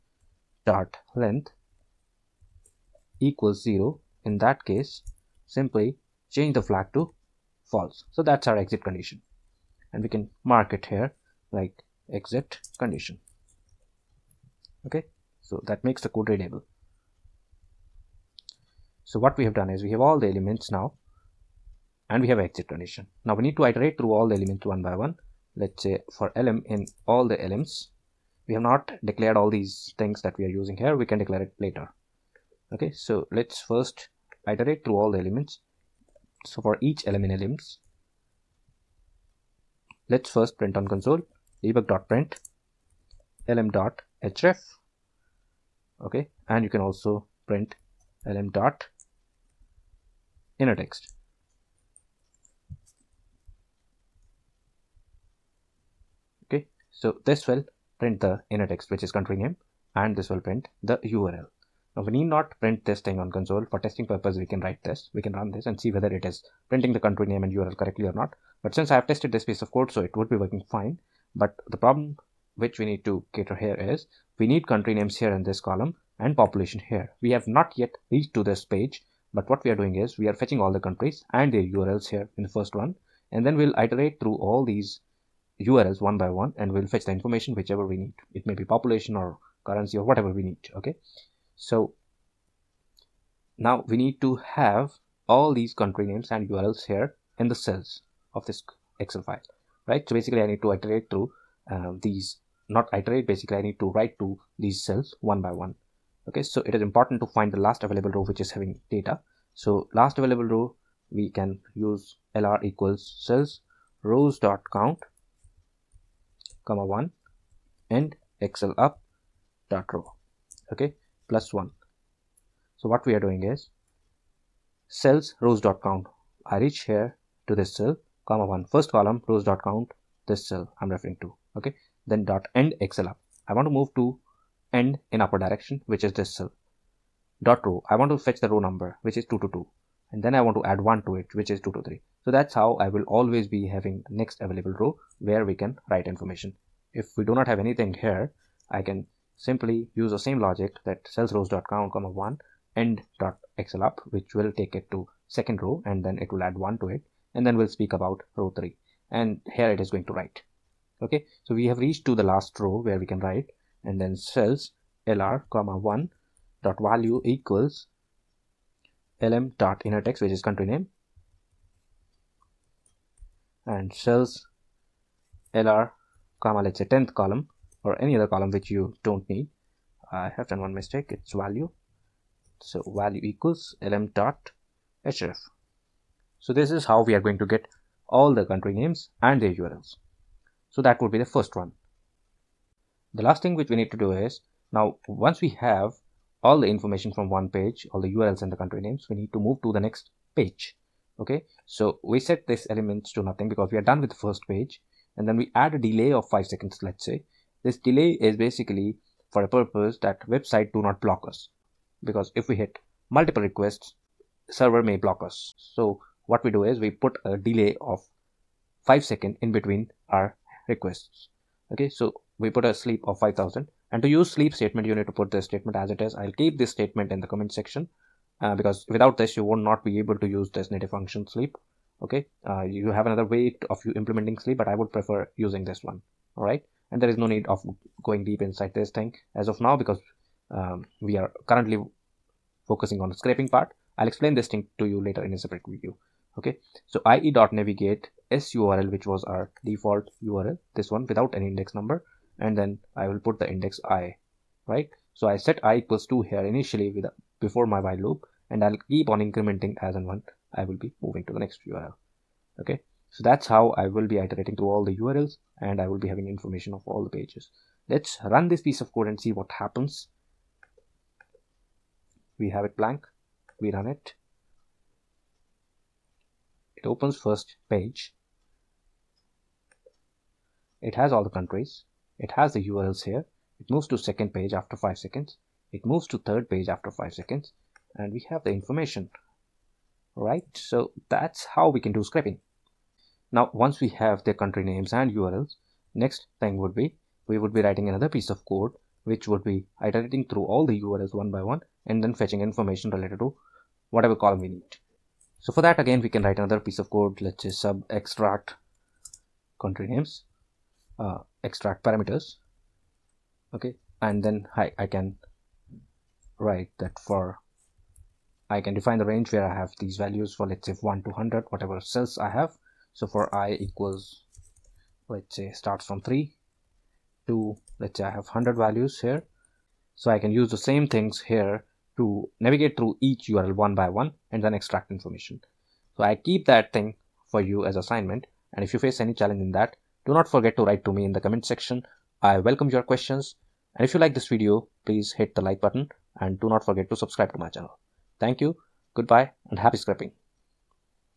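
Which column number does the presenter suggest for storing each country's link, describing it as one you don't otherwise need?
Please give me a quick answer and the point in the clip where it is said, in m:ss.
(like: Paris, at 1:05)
10, at 2:56.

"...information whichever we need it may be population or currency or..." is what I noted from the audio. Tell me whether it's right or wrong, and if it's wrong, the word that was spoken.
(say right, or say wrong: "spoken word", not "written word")
right.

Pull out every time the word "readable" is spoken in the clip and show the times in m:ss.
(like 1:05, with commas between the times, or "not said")
0:16.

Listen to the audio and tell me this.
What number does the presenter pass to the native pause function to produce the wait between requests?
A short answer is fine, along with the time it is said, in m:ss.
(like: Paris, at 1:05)
5000, at 3:43.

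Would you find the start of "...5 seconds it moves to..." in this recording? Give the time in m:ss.
4:44.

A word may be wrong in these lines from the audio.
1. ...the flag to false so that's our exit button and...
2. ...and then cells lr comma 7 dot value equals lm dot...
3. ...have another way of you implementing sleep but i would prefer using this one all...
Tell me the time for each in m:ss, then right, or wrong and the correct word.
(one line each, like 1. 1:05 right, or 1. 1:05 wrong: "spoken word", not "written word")
1. 0:06 wrong: "condition", not "button"
2. 2:43 wrong: "1", not "7"
3. 3:52 right.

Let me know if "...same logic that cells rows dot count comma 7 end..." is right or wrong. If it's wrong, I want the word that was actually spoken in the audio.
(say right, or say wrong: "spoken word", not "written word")
wrong: "1", not "7".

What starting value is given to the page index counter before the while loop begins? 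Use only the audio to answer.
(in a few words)
2.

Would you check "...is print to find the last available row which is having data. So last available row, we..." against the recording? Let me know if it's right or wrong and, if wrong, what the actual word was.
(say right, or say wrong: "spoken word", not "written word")
wrong: "important", not "print".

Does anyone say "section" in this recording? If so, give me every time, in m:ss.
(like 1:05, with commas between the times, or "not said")
3:47, 5:41.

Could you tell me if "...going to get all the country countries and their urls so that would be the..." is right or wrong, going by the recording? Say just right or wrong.
wrong.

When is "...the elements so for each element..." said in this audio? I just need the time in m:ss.
0:35.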